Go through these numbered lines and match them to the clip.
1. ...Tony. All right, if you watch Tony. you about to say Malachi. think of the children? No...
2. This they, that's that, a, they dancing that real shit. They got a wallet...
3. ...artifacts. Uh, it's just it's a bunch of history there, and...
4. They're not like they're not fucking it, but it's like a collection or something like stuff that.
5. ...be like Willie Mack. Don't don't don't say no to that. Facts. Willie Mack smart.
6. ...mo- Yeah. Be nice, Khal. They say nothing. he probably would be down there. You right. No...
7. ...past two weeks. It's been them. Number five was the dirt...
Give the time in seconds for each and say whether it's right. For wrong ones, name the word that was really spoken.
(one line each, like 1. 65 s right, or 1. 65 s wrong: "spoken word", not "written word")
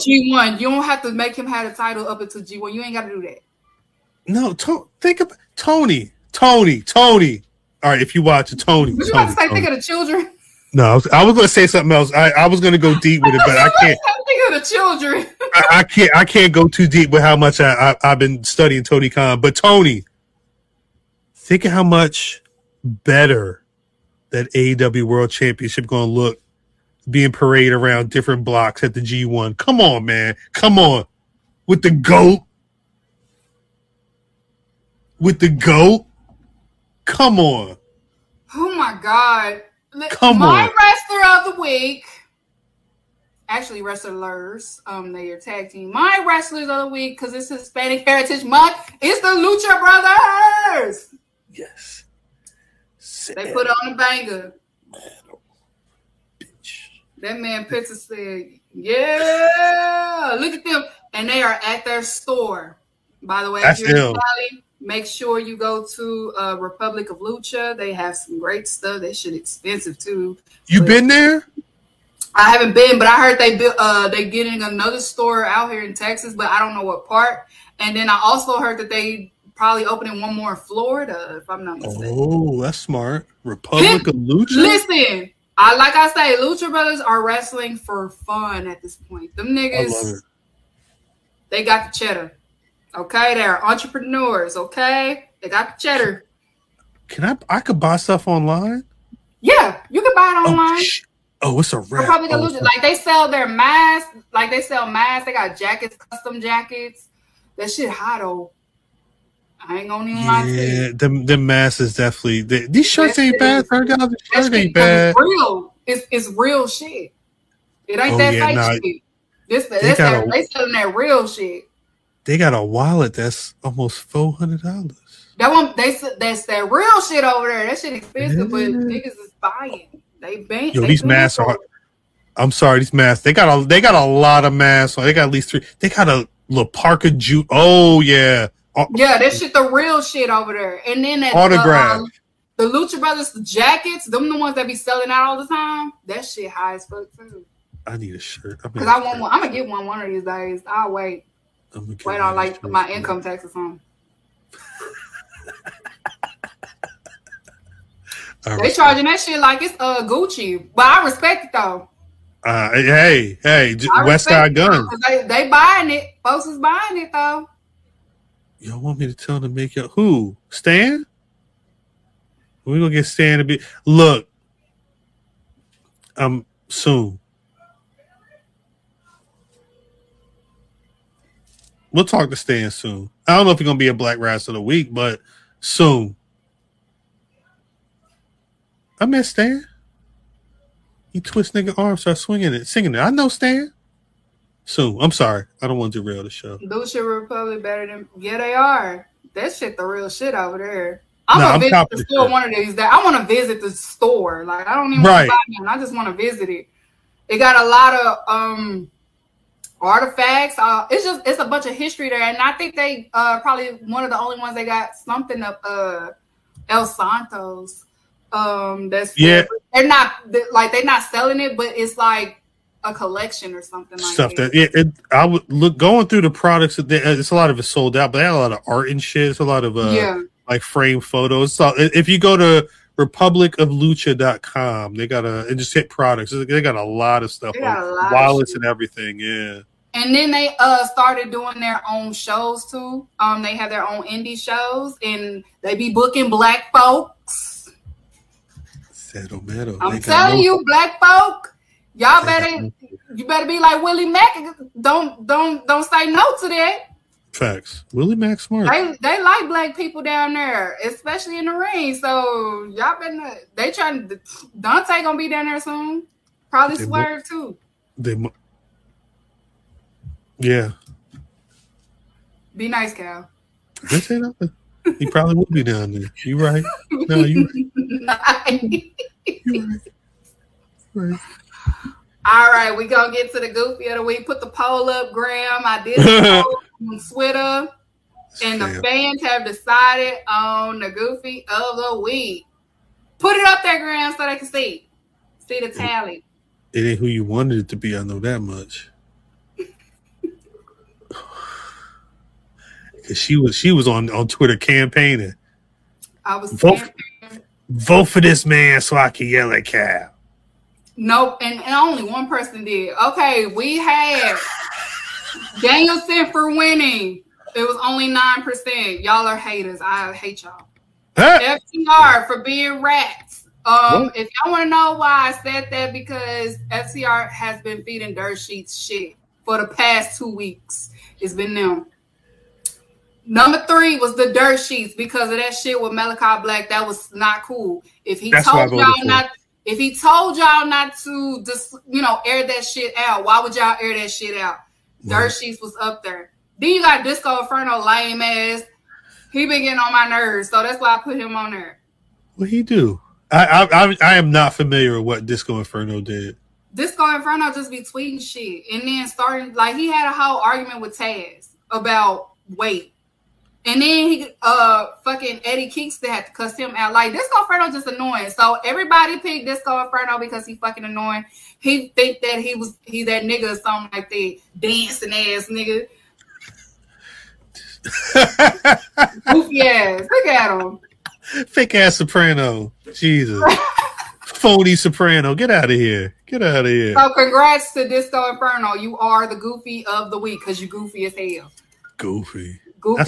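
1. 6 s wrong: "Tony", not "Malachi"
2. 119 s wrong: "selling", not "dancing"
3. 209 s right
4. 219 s wrong: "selling", not "fucking"
5. 253 s right
6. 268 s right
7. 329 s wrong: "three", not "five".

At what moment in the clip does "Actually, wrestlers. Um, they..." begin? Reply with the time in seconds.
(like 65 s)
43 s.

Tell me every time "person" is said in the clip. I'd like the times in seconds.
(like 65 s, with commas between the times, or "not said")
312 s.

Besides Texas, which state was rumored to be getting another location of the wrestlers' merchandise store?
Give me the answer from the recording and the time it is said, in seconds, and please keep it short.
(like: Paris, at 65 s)
Florida, at 80 s.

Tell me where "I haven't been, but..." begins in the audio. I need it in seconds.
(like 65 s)
72 s.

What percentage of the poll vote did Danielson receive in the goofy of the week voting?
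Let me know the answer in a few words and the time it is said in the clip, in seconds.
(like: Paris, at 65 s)
9%, at 318 s.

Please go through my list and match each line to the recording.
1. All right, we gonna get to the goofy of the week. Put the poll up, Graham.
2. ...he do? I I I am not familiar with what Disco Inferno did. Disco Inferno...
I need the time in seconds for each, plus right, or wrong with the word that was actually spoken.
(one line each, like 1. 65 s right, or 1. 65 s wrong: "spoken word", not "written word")
1. 282 s right
2. 352 s right.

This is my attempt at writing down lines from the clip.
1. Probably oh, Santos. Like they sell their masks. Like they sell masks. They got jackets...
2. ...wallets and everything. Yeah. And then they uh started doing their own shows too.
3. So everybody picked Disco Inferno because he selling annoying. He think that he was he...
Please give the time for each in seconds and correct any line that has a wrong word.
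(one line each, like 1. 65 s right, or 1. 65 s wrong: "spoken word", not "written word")
1. 102 s wrong: "Lucha", not "Santos"
2. 237 s right
3. 368 s wrong: "fucking", not "selling".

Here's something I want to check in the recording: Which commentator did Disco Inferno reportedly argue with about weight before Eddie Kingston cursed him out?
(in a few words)
Taz.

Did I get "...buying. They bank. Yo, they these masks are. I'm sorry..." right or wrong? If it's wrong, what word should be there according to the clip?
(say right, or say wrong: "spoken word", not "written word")
right.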